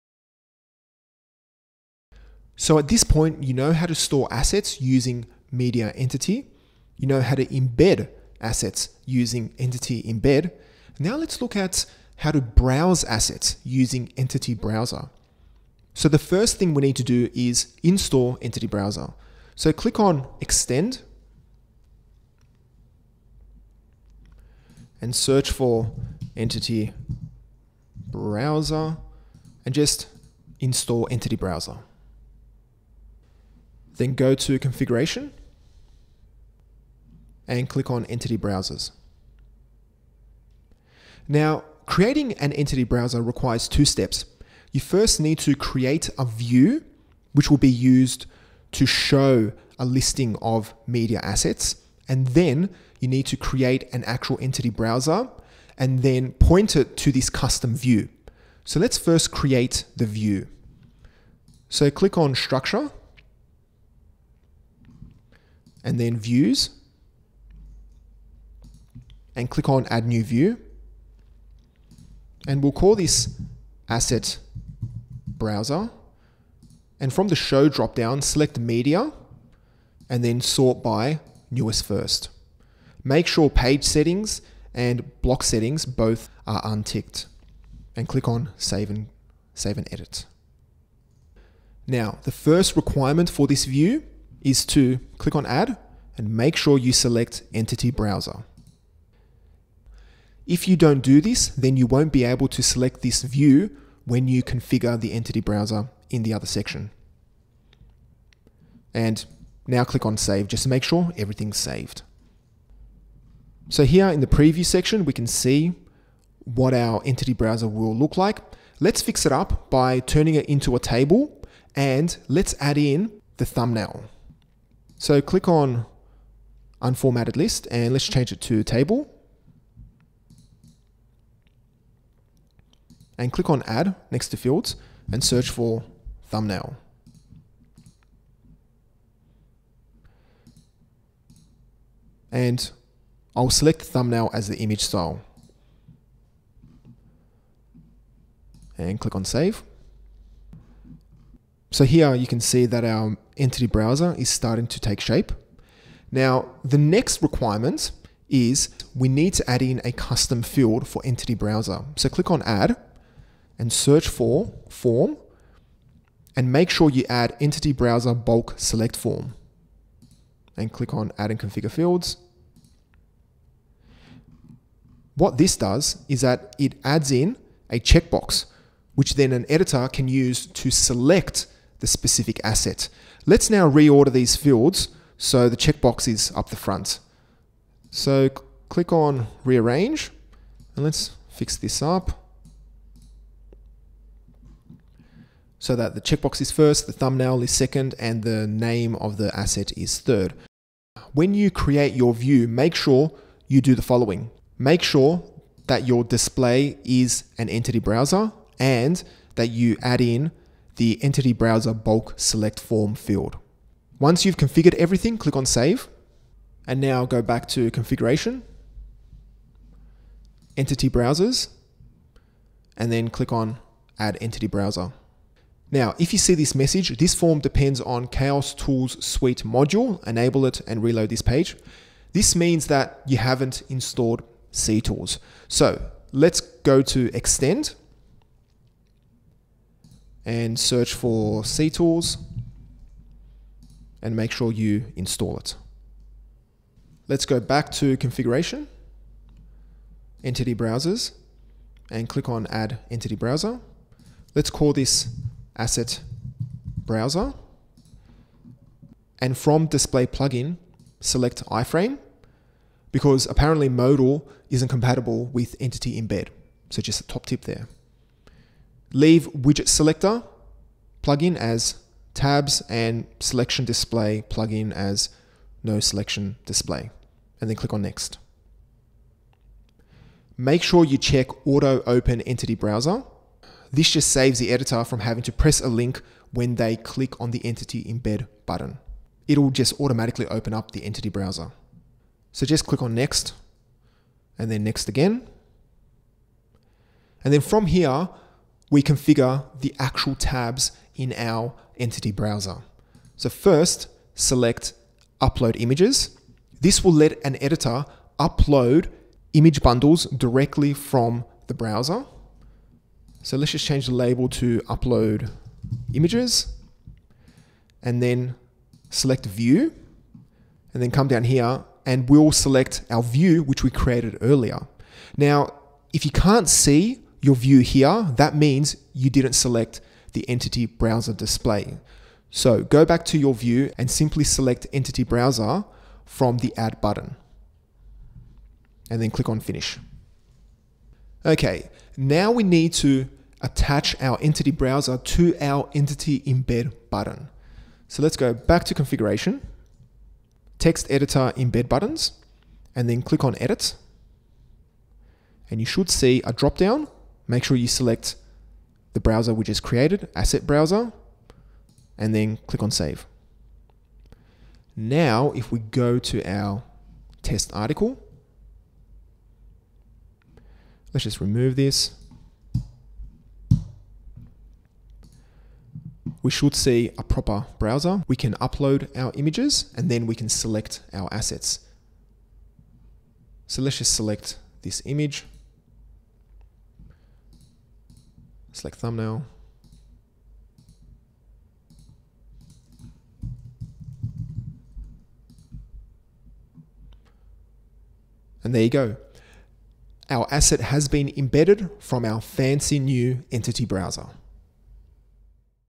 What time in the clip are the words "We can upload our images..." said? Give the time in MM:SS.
06:18.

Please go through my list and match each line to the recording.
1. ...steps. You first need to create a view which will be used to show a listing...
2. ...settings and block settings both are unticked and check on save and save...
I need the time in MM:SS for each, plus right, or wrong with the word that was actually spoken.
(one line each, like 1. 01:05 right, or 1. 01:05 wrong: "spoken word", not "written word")
1. 00:43 right
2. 01:23 wrong: "click", not "check".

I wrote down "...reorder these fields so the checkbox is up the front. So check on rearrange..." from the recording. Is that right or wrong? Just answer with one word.
wrong.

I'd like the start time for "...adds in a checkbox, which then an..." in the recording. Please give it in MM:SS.
02:56.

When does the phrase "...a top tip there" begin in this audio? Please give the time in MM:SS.
04:27.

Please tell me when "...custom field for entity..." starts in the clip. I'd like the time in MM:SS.
02:39.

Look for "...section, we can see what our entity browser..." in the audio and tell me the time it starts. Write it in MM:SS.
01:54.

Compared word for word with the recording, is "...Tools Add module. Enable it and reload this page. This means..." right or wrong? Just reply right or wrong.
wrong.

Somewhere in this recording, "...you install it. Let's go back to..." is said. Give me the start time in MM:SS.
04:04.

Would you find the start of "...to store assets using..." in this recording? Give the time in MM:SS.
00:03.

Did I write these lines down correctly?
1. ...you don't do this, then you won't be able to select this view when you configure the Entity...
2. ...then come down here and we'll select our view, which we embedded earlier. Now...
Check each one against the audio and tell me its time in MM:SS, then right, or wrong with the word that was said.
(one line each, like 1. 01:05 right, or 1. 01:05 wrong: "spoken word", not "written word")
1. 01:40 right
2. 05:20 wrong: "created", not "embedded".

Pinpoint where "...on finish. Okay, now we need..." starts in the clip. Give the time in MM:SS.
05:39.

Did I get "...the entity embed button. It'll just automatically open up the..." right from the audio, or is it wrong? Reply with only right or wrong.
right.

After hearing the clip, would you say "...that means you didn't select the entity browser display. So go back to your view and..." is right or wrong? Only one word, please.
right.